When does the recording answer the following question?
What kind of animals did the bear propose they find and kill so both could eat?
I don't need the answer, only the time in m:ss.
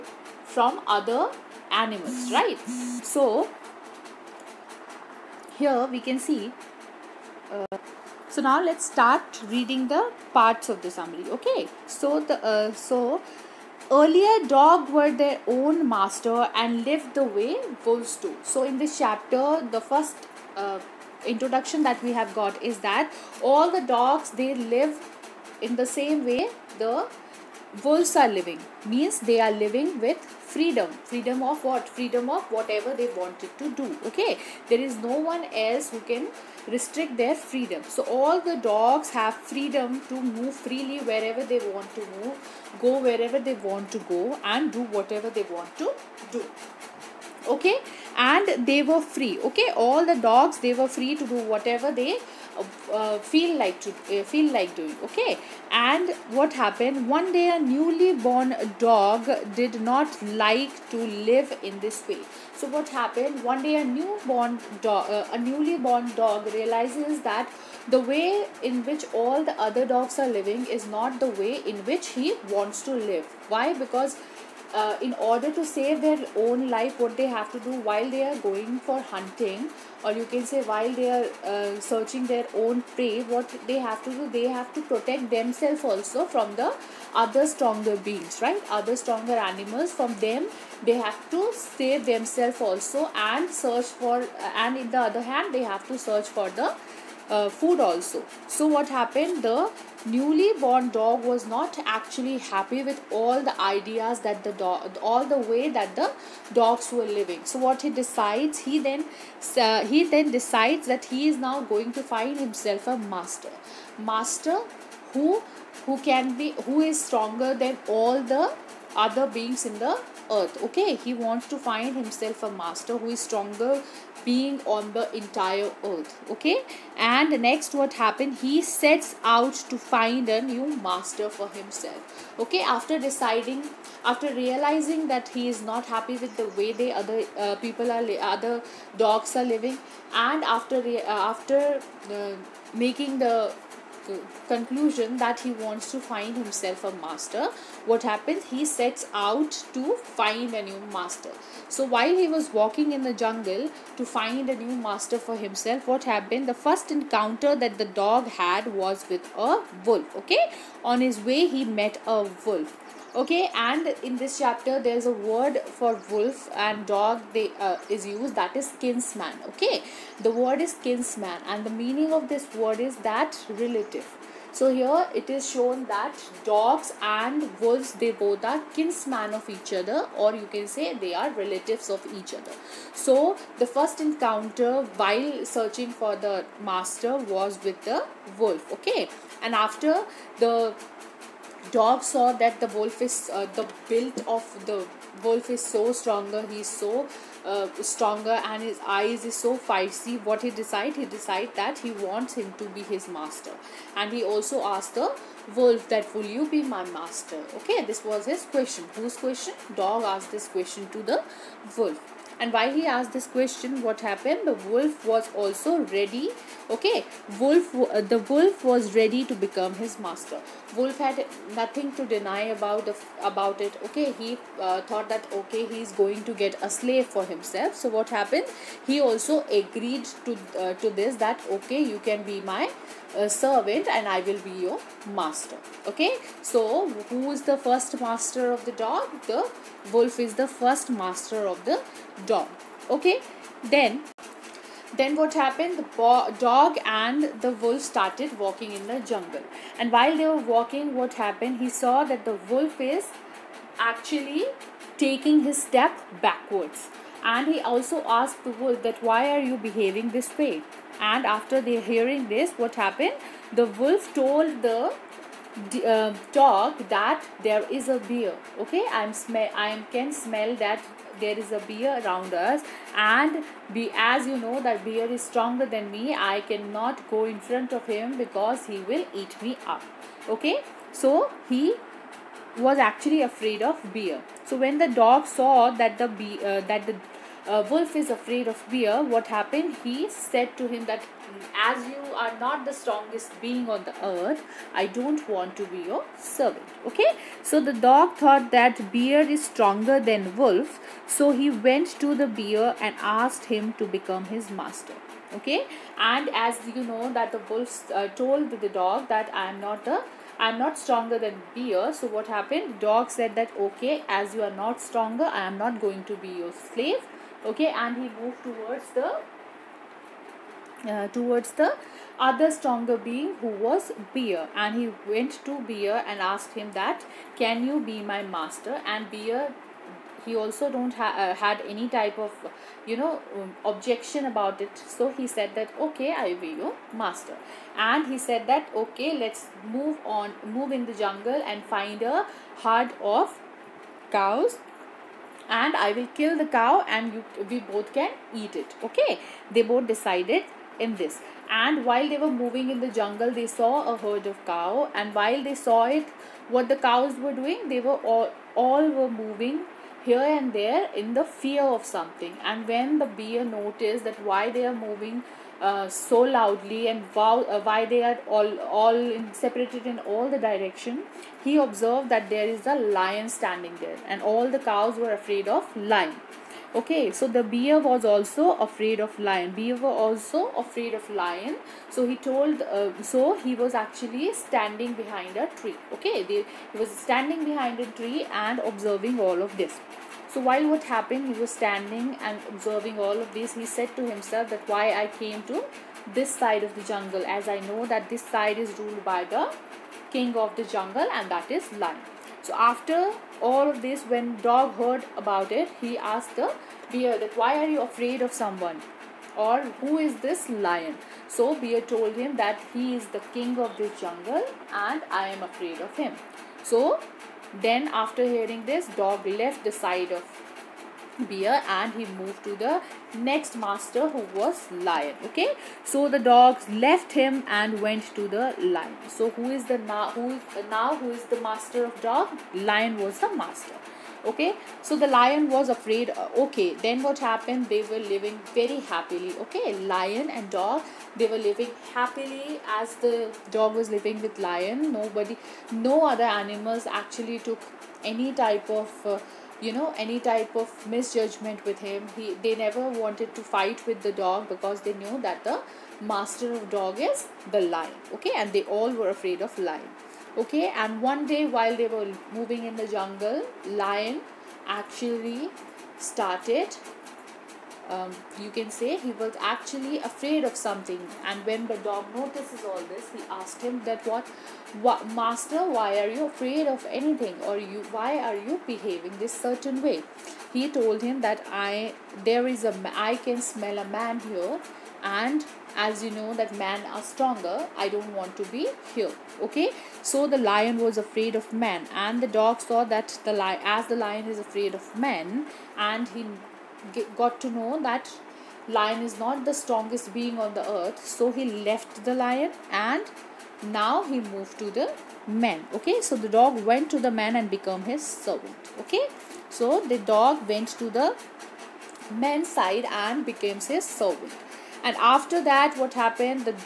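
5:42.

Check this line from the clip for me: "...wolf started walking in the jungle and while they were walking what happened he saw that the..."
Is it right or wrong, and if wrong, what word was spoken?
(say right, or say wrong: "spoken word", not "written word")
right.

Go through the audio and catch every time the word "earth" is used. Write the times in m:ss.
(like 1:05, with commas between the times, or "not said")
2:00, 2:05, 4:54, 8:20.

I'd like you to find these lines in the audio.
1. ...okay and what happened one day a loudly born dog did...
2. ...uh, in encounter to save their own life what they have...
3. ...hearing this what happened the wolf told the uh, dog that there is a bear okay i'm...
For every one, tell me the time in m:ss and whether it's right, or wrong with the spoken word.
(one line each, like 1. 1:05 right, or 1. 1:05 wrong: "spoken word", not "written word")
1. 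0:55 wrong: "newly", not "loudly"
2. 1:14 wrong: "order", not "encounter"
3. 4:21 right.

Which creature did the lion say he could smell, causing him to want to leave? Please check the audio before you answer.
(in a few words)
A man.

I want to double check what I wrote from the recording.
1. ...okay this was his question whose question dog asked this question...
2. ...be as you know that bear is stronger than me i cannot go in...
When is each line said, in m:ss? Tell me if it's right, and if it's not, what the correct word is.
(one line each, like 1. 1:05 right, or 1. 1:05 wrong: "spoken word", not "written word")
1. 3:27 right
2. 4:33 right.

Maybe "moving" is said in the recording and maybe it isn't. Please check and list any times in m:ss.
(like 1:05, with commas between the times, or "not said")
5:52, 5:59, 6:04, 7:42.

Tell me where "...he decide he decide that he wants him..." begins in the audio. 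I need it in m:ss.
3:20.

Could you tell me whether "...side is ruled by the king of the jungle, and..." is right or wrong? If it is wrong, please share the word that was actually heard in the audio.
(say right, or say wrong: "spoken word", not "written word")
right.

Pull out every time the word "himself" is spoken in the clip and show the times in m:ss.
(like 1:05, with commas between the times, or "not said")
1:52, 2:01, 2:11, 2:26, 2:35, 3:47, 6:34.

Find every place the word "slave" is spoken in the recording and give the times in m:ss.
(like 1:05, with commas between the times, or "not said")
3:46, 5:16.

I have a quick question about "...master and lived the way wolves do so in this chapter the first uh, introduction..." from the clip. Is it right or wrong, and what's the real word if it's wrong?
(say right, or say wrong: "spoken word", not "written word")
right.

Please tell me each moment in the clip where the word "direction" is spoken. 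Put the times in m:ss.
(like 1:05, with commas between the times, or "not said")
6:10.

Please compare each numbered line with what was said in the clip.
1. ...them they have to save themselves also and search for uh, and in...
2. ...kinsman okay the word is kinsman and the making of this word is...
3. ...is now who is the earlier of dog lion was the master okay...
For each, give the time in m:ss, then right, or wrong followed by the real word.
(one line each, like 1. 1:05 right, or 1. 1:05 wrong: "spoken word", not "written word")
1. 1:30 right
2. 2:48 wrong: "meaning", not "making"
3. 7:10 wrong: "master", not "earlier".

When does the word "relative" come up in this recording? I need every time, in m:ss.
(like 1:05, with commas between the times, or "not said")
2:53, 3:01.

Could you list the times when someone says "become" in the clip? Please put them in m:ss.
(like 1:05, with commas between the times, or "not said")
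3:39, 5:03.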